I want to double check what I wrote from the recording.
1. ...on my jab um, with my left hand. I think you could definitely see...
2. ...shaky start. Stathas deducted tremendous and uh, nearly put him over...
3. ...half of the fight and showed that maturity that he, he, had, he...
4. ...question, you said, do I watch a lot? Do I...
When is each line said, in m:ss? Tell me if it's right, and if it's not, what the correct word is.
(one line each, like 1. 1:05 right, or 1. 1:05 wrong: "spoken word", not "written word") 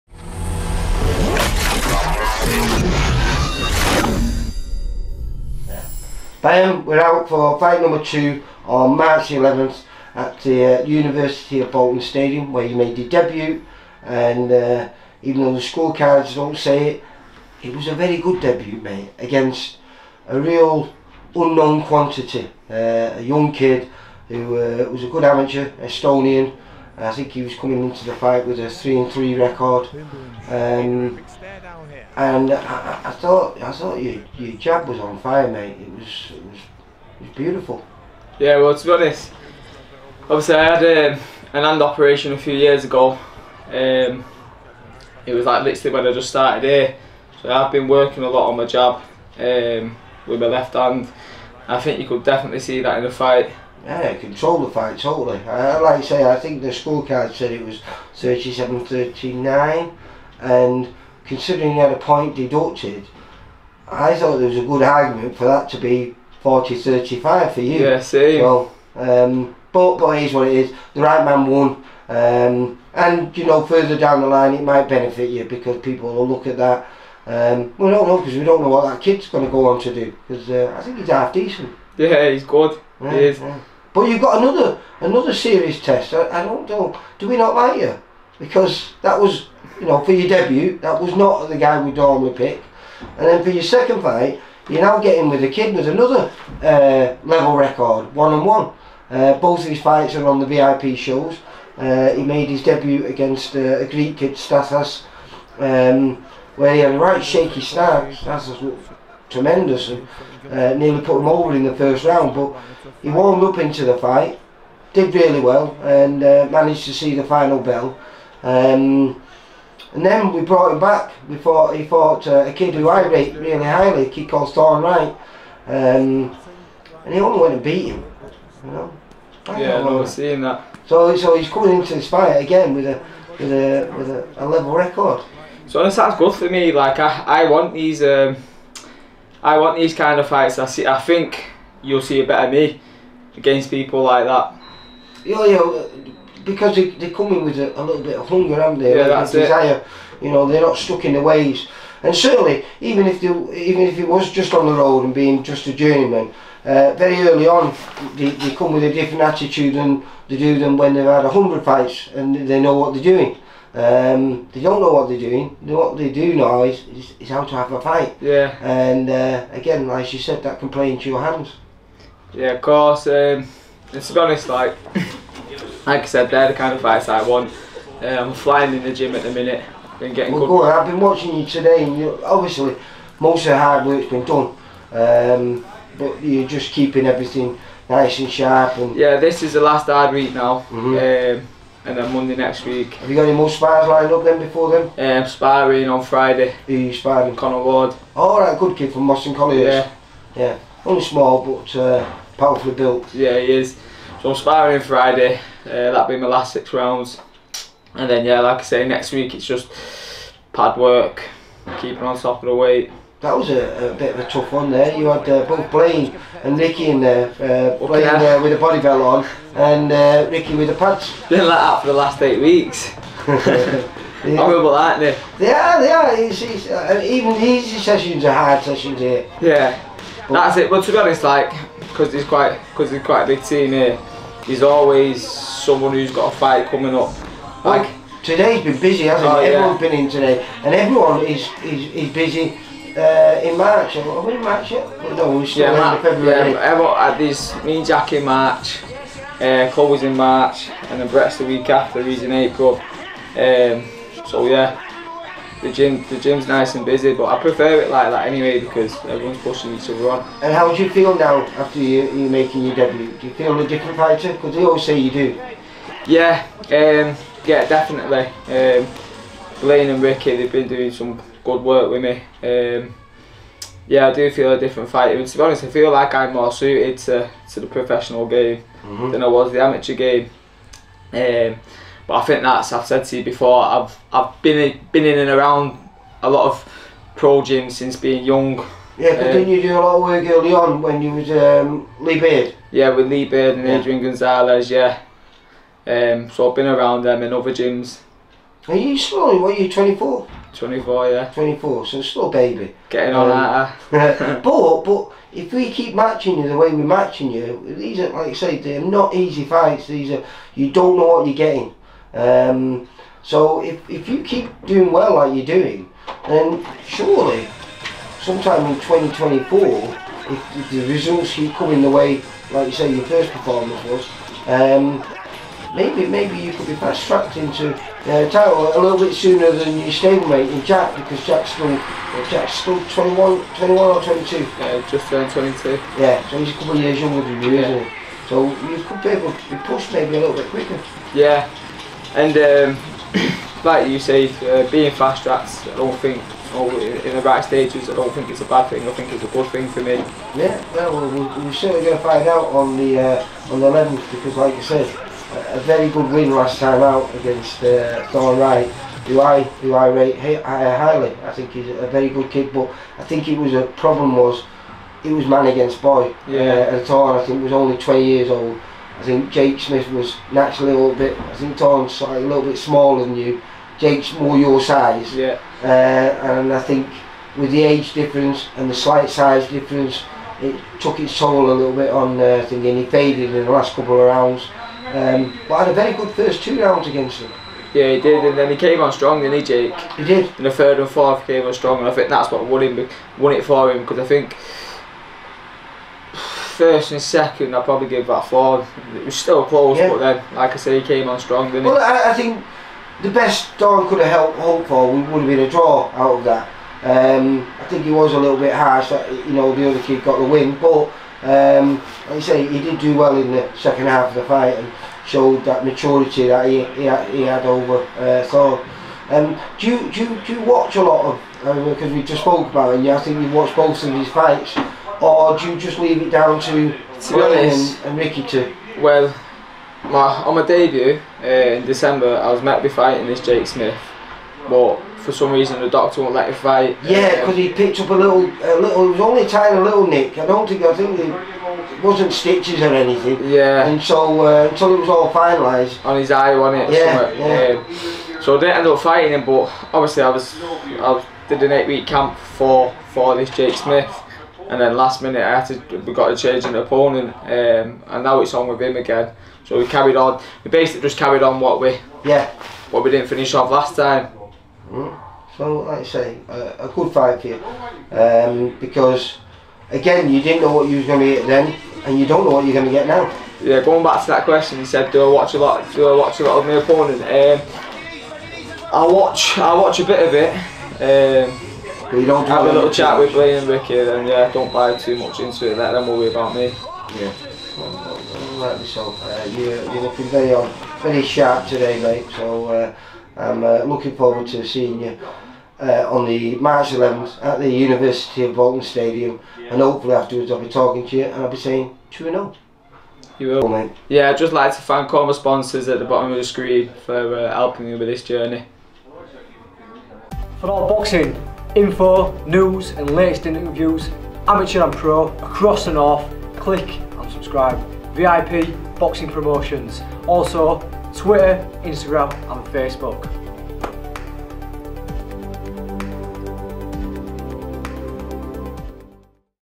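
1. 0:48 right
2. 1:47 wrong: "looked", not "deducted"
3. 6:53 right
4. 7:54 right.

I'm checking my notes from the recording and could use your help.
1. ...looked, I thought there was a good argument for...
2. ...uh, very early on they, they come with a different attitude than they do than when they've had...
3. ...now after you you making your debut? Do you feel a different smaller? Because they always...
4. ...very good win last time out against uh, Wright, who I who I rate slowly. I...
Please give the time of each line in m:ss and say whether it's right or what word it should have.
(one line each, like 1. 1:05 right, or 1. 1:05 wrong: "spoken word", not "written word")
1. 1:02 wrong: "deducted", not "looked"
2. 2:36 right
3. 4:21 wrong: "fighter", not "smaller"
4. 5:55 wrong: "highly", not "slowly".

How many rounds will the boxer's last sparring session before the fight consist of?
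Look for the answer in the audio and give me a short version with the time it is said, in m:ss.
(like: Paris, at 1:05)
6, at 3:26.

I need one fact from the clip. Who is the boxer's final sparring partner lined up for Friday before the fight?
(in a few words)
Connor Ward.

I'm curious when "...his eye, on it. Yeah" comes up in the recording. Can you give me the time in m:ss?
7:25.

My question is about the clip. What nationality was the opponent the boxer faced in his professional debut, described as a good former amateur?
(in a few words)
Estonian.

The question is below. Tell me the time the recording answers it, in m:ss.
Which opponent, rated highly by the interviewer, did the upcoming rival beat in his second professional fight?
2:04.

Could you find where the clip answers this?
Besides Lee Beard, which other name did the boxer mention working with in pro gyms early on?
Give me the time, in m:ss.
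4:53.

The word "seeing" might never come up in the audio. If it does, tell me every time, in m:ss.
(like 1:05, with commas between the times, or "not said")
2:10, 8:14.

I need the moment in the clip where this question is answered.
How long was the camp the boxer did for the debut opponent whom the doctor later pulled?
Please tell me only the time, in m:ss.
7:31.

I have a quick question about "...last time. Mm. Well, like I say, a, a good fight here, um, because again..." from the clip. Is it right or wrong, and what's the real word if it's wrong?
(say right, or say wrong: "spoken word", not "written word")
right.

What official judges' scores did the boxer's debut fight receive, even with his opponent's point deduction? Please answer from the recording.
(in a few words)
37-39.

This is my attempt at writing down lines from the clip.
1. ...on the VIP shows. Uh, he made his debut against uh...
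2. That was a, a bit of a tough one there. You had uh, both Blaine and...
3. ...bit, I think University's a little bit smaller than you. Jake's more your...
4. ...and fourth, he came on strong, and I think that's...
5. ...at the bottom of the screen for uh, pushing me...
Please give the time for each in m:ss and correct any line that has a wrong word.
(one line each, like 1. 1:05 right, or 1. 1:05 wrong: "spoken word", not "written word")
1. 1:40 right
2. 3:33 right
3. 6:10 wrong: "Don", not "University"
4. 6:30 right
5. 8:25 wrong: "helping", not "pushing".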